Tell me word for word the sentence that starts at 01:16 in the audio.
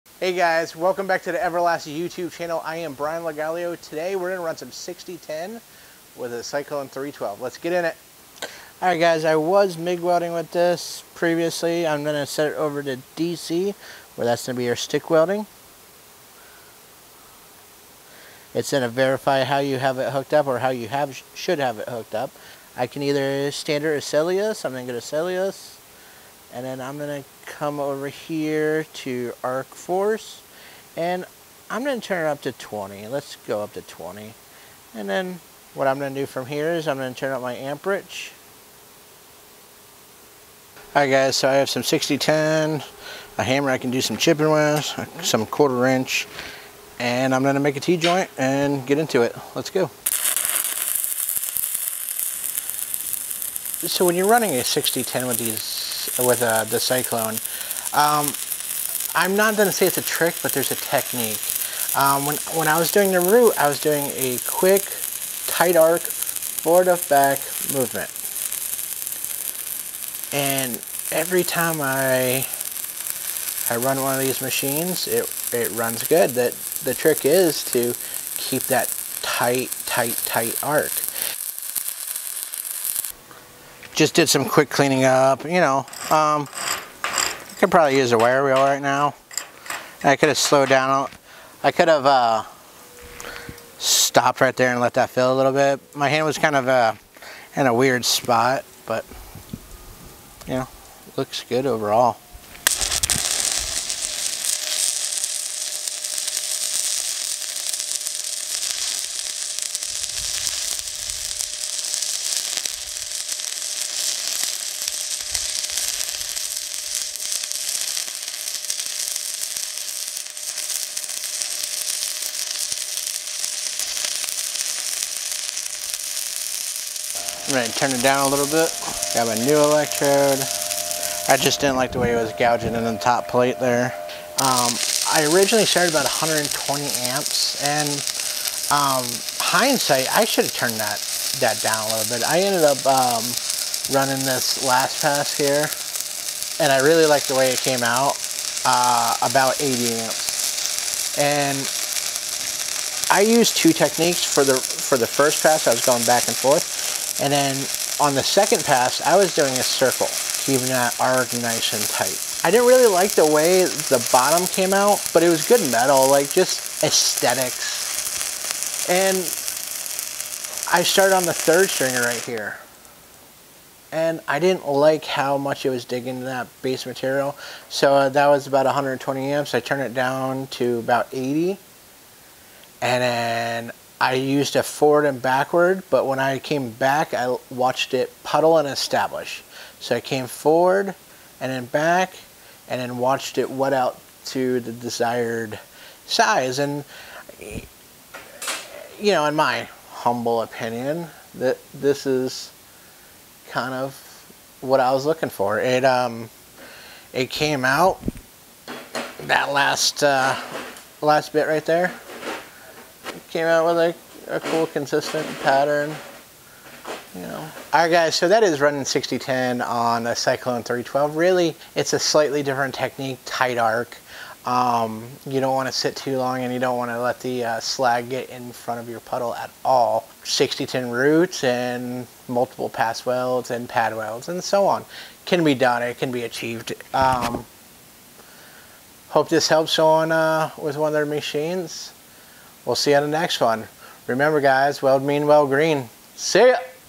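That The trick is to keep that tight, tight, tight arc.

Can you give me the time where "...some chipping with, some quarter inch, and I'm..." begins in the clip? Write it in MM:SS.
00:44.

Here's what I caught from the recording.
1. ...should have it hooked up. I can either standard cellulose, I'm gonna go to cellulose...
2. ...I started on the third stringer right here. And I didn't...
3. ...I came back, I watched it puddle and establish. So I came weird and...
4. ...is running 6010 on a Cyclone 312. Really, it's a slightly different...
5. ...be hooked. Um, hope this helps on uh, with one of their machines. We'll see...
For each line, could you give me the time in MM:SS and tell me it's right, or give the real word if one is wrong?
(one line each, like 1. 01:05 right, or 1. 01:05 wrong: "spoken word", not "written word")
1. 00:21 right
2. 02:50 right
3. 03:06 wrong: "forward", not "weird"
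4. 03:38 right
5. 03:56 wrong: "achieved", not "hooked".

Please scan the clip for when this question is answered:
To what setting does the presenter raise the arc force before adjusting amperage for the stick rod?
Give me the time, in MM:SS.
00:31.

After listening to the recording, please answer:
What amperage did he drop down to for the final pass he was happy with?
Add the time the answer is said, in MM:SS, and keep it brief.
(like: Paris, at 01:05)
80 amps, at 02:29.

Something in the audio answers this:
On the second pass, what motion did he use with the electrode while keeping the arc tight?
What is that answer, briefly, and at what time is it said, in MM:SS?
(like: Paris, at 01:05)
A circle, at 02:39.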